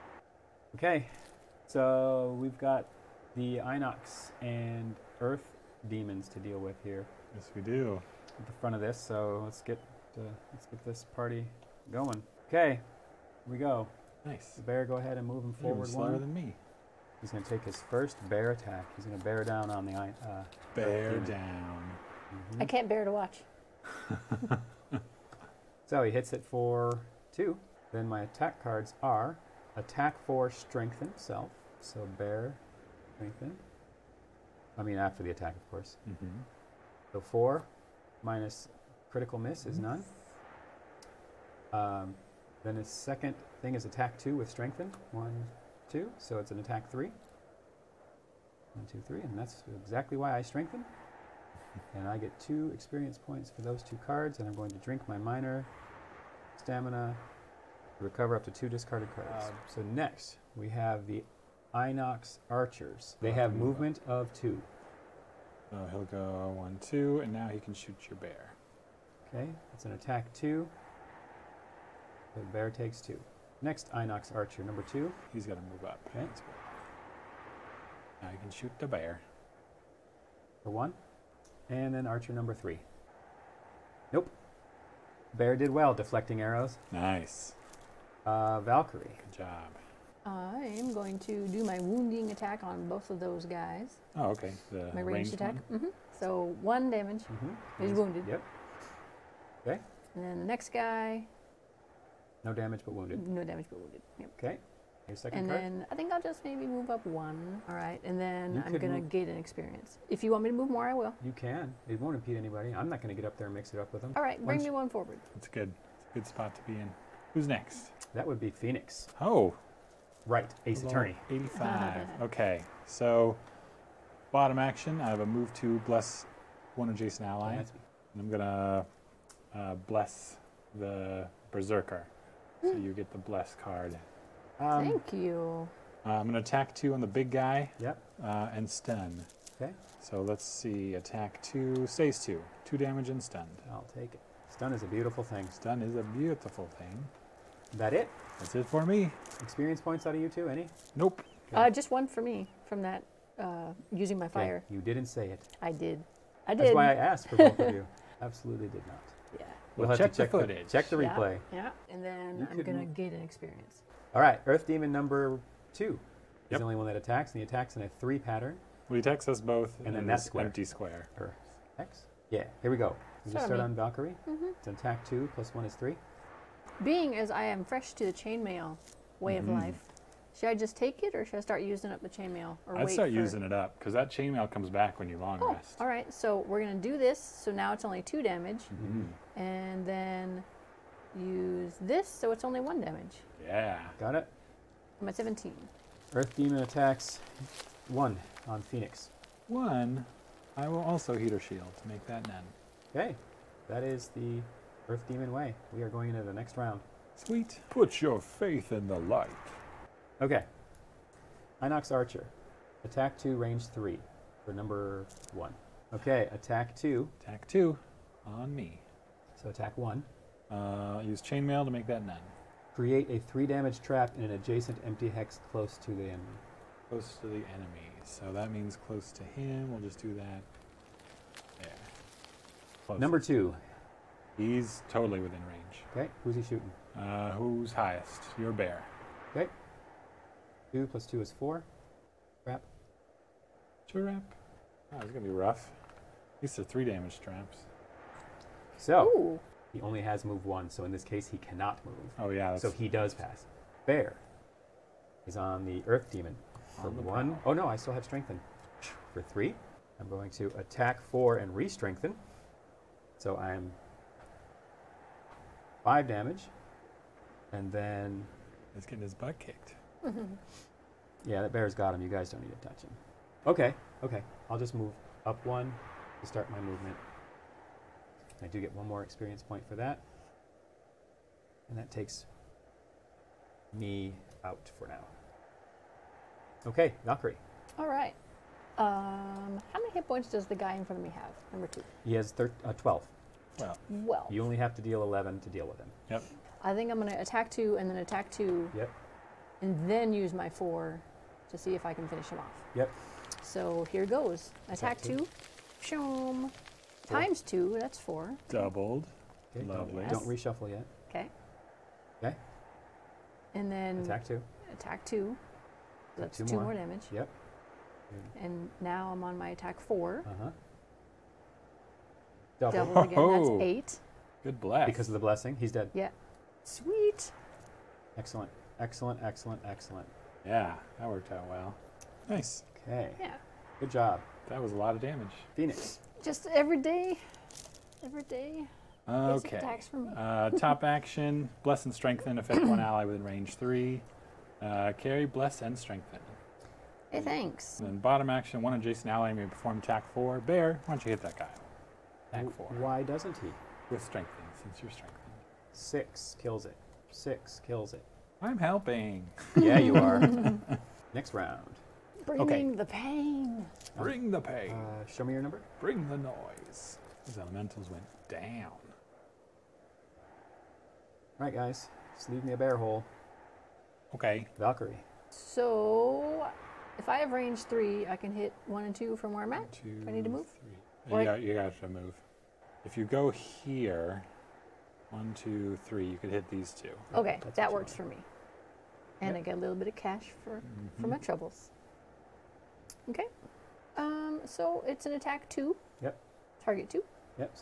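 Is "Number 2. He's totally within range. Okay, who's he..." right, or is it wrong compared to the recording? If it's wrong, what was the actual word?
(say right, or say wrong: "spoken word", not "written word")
right.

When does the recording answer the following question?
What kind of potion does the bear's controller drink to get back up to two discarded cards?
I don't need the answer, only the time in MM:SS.
00:55.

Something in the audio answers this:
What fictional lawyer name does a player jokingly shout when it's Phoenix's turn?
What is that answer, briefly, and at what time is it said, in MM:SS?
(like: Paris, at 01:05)
Wright, Ace Level Attorney, at 02:00.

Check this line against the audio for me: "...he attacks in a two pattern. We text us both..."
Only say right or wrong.
wrong.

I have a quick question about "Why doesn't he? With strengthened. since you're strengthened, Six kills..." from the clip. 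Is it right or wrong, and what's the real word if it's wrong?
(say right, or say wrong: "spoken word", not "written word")
right.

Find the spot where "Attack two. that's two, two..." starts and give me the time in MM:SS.
05:14.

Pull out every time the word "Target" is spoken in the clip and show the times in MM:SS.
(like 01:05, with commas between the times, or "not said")
06:36.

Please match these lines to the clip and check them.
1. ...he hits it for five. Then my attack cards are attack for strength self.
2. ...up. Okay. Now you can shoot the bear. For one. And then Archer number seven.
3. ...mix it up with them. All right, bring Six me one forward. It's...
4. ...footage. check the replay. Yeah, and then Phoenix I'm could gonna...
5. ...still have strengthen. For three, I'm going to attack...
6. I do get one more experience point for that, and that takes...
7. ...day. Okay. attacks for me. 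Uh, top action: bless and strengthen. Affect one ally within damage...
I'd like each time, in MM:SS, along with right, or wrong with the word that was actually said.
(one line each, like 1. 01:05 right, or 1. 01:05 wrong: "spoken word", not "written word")
1. 00:26 wrong: "two", not "five"
2. 01:15 wrong: "three", not "seven"
3. 01:53 wrong: "Once", not "Six"
4. 02:40 wrong: "You", not "Phoenix"
5. 04:17 right
6. 04:38 right
7. 05:38 wrong: "range", not "damage".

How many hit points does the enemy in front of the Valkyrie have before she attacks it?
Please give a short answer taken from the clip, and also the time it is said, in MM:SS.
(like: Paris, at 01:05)
12, at 04:52.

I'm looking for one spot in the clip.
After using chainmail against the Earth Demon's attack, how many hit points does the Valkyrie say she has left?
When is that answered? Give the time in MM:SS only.
03:15.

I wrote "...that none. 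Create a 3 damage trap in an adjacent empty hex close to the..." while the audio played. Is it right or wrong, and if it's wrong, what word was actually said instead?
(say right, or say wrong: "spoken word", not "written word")
right.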